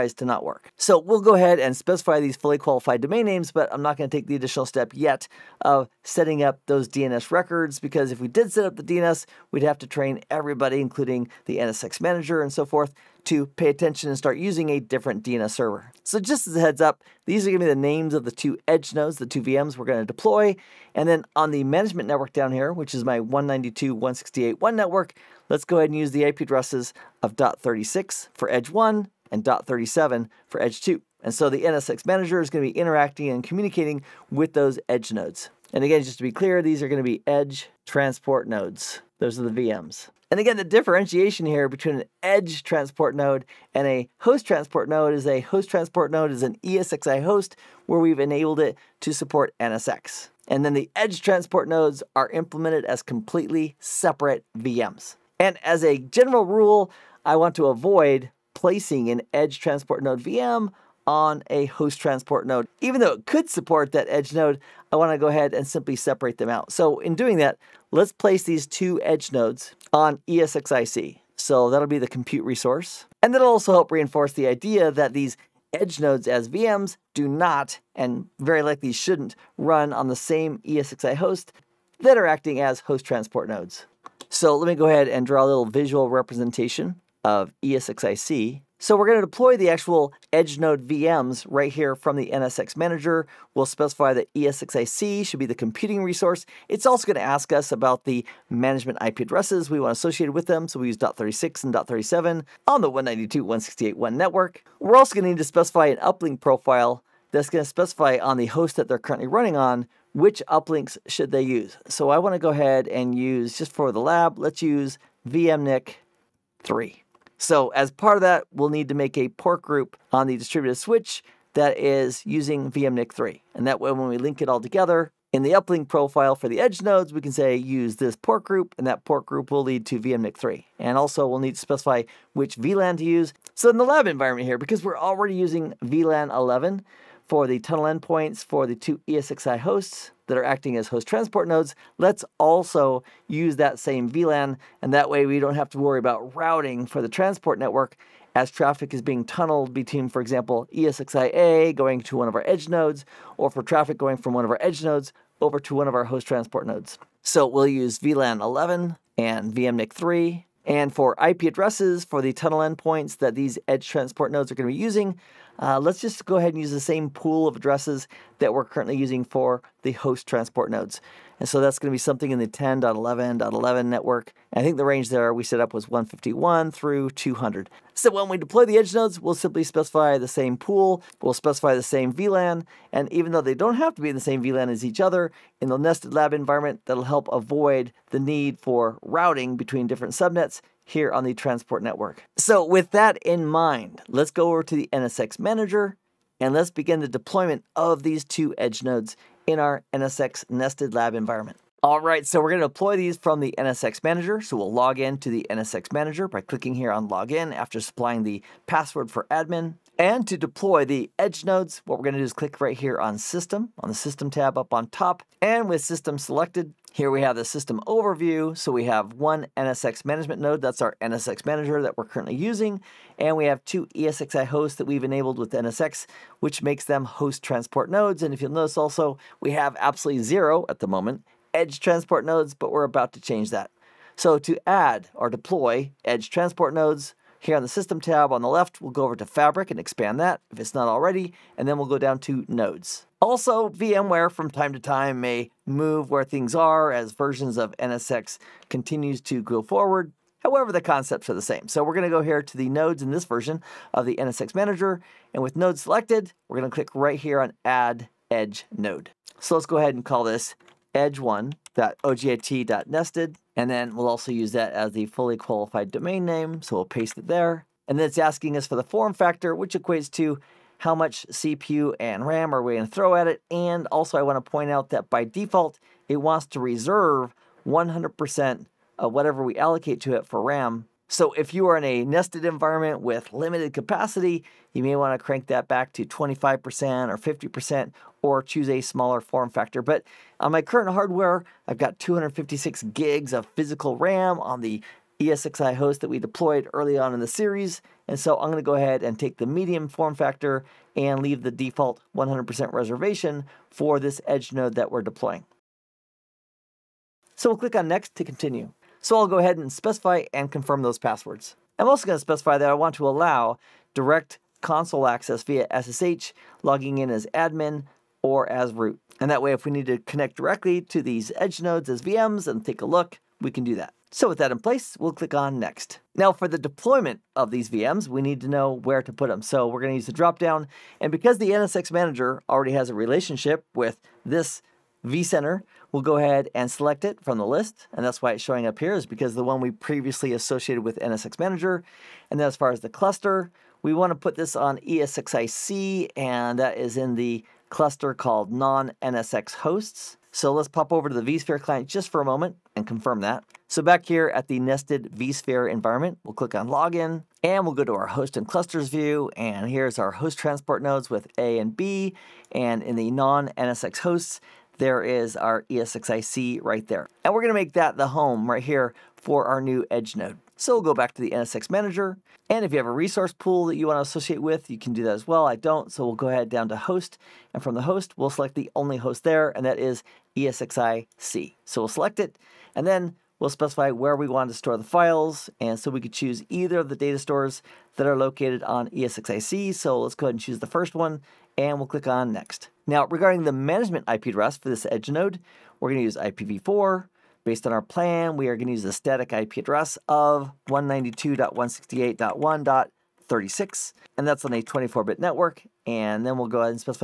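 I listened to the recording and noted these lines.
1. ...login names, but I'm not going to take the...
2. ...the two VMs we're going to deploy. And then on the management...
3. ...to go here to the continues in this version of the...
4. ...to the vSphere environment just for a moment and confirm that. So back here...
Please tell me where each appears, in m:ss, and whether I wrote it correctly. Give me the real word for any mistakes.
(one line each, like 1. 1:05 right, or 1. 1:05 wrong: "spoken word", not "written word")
1. 0:03 wrong: "domain", not "login"
2. 0:19 right
3. 4:12 wrong: "nodes", not "continues"
4. 5:51 wrong: "client", not "environment".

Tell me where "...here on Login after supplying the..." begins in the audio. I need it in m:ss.
3:26.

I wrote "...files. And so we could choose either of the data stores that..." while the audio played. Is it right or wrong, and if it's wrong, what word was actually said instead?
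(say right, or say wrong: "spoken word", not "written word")
right.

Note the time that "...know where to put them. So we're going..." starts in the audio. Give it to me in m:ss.
5:28.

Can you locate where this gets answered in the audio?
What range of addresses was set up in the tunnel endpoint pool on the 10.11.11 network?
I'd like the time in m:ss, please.
2:55.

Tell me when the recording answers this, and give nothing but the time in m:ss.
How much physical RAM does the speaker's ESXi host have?
4:51.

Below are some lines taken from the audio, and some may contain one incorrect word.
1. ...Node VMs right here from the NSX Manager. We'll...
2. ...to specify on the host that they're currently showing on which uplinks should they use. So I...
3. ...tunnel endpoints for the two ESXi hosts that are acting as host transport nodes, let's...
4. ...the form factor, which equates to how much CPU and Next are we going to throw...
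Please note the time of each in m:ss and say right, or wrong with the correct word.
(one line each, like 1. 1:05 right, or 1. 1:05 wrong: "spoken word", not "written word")
1. 1:30 right
2. 1:47 wrong: "running", not "showing"
3. 2:17 right
4. 4:28 wrong: "RAM", not "Next".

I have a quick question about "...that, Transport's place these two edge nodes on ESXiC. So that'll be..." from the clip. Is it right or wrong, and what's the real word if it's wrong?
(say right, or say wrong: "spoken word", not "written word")
wrong: "Let", not "Transport".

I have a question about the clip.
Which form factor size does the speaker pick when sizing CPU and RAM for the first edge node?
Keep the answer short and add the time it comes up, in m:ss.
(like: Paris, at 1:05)
medium, at 4:59.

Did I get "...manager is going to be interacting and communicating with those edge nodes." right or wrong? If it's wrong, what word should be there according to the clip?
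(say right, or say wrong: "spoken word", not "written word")
right.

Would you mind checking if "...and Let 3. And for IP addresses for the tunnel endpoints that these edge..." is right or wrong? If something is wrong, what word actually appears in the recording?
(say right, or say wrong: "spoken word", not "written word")
wrong: "VMNIC", not "Let".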